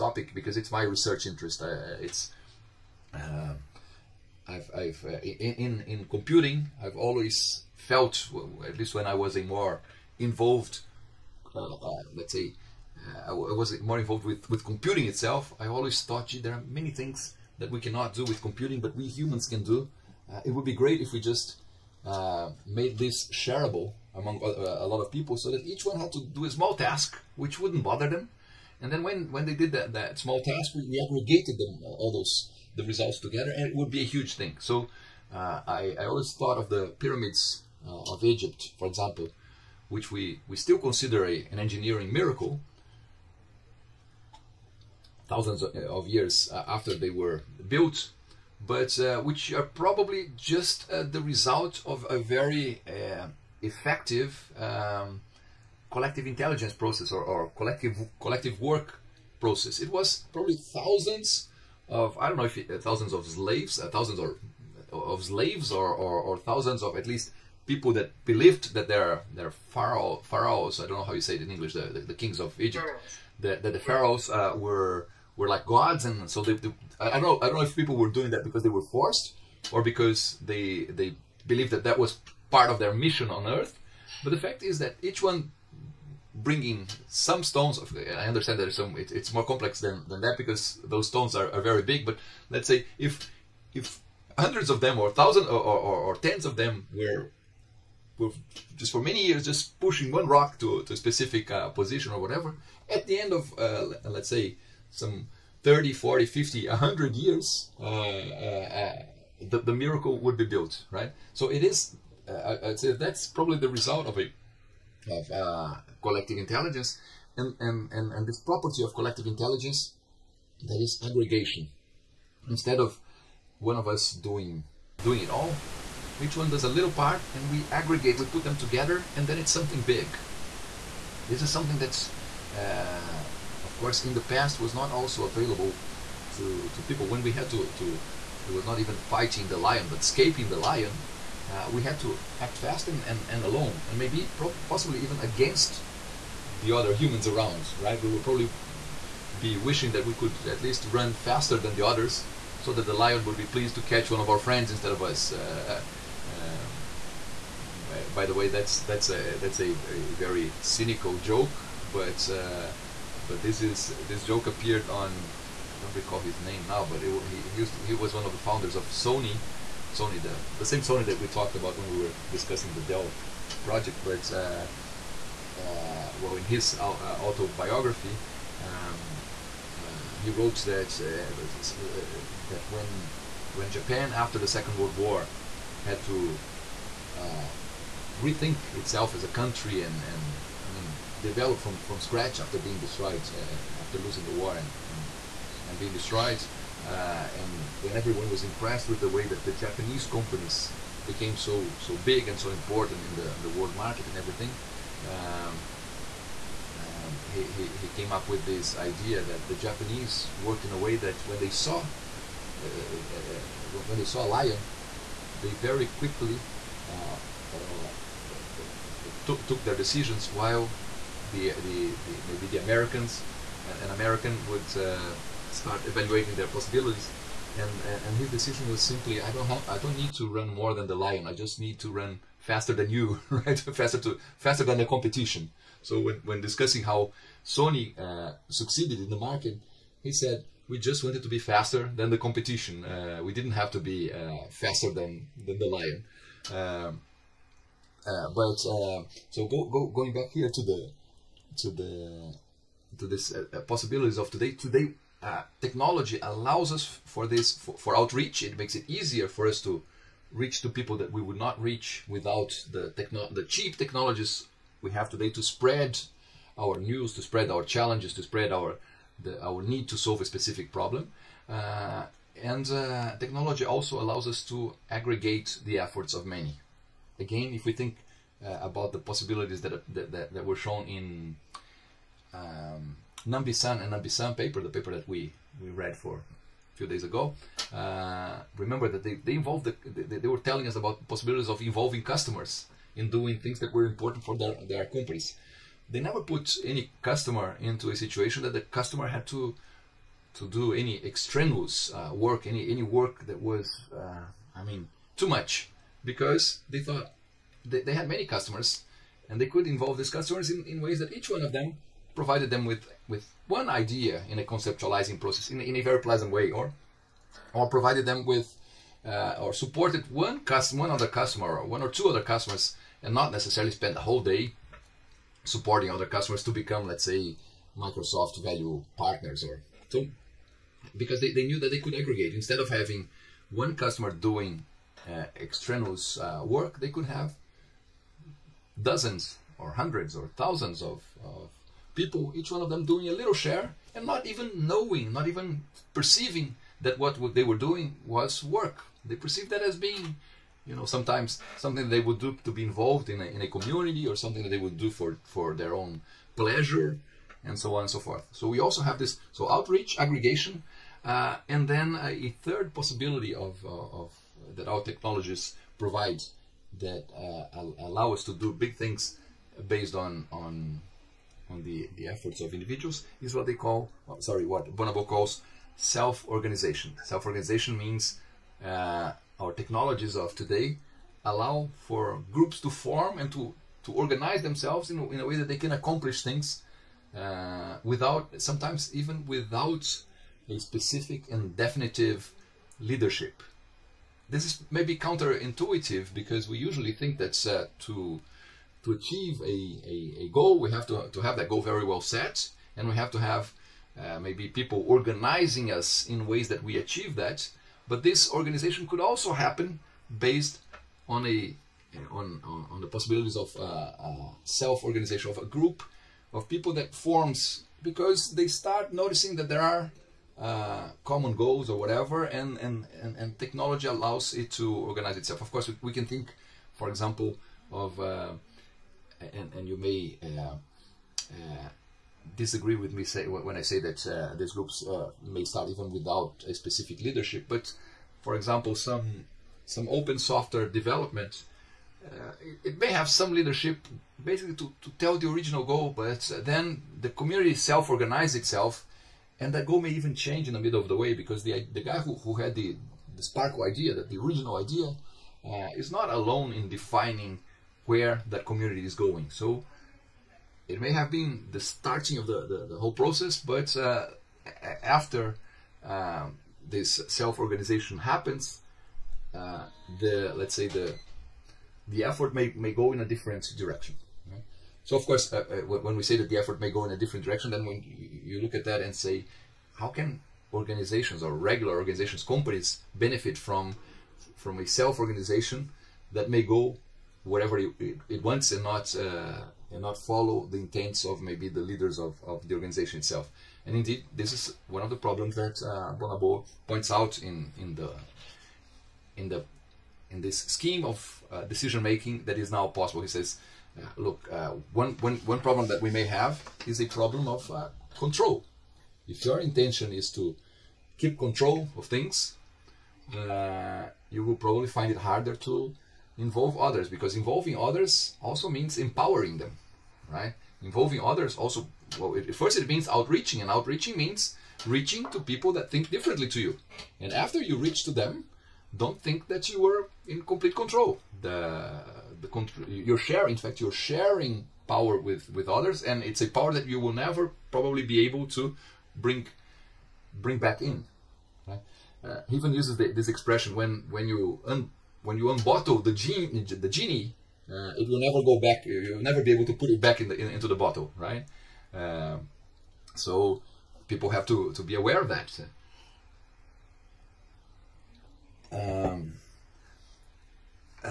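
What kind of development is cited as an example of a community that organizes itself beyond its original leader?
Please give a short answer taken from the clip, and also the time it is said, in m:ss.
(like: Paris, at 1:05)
open software development, at 7:19.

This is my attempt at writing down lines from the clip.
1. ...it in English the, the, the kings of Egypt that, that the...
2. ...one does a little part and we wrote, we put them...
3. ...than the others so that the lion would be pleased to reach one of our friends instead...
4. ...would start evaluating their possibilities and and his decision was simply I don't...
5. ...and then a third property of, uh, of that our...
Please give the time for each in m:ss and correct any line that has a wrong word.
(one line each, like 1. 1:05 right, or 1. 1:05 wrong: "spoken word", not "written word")
1. 1:11 right
2. 2:06 wrong: "aggregate", not "wrote"
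3. 2:31 wrong: "catch", not "reach"
4. 3:44 right
5. 6:01 wrong: "possibility", not "property".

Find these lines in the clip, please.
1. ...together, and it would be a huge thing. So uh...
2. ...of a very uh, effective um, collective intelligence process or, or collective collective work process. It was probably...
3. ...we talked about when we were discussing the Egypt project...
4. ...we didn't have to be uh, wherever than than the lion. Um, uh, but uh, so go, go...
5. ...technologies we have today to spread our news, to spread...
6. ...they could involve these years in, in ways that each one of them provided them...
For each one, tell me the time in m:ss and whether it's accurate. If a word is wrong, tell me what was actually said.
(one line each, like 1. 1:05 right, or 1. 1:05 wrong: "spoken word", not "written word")
1. 0:33 right
2. 0:51 right
3. 2:51 wrong: "Dell", not "Egypt"
4. 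4:03 wrong: "faster", not "wherever"
5. 4:23 right
6. 5:09 wrong: "customers", not "years".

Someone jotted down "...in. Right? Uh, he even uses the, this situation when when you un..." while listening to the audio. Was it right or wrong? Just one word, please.
wrong.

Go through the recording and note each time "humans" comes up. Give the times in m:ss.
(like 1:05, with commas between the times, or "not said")
0:19, 2:26.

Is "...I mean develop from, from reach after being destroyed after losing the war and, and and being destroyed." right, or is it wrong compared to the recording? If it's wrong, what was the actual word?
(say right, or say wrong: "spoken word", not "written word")
wrong: "scratch", not "reach".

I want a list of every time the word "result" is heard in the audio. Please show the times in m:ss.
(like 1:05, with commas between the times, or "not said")
0:32, 0:51, 1:53.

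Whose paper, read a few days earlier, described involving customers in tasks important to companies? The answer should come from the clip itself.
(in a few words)
Nambisan.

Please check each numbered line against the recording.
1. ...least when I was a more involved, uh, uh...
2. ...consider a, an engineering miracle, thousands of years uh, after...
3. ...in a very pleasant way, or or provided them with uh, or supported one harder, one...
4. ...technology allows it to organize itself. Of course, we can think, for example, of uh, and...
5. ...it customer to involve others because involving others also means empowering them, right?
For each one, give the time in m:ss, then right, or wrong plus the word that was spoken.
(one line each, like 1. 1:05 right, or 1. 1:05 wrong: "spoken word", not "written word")
1. 0:08 right
2. 0:40 right
3. 5:15 wrong: "customer", not "harder"
4. 7:03 right
5. 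8:34 wrong: "harder", not "customer".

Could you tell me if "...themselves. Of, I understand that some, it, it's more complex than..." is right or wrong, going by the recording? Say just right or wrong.
wrong.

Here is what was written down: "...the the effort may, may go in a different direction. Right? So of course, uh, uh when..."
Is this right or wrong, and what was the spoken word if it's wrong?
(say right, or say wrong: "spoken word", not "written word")
right.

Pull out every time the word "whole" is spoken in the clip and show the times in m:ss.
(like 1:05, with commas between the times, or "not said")
5:23, 7:42.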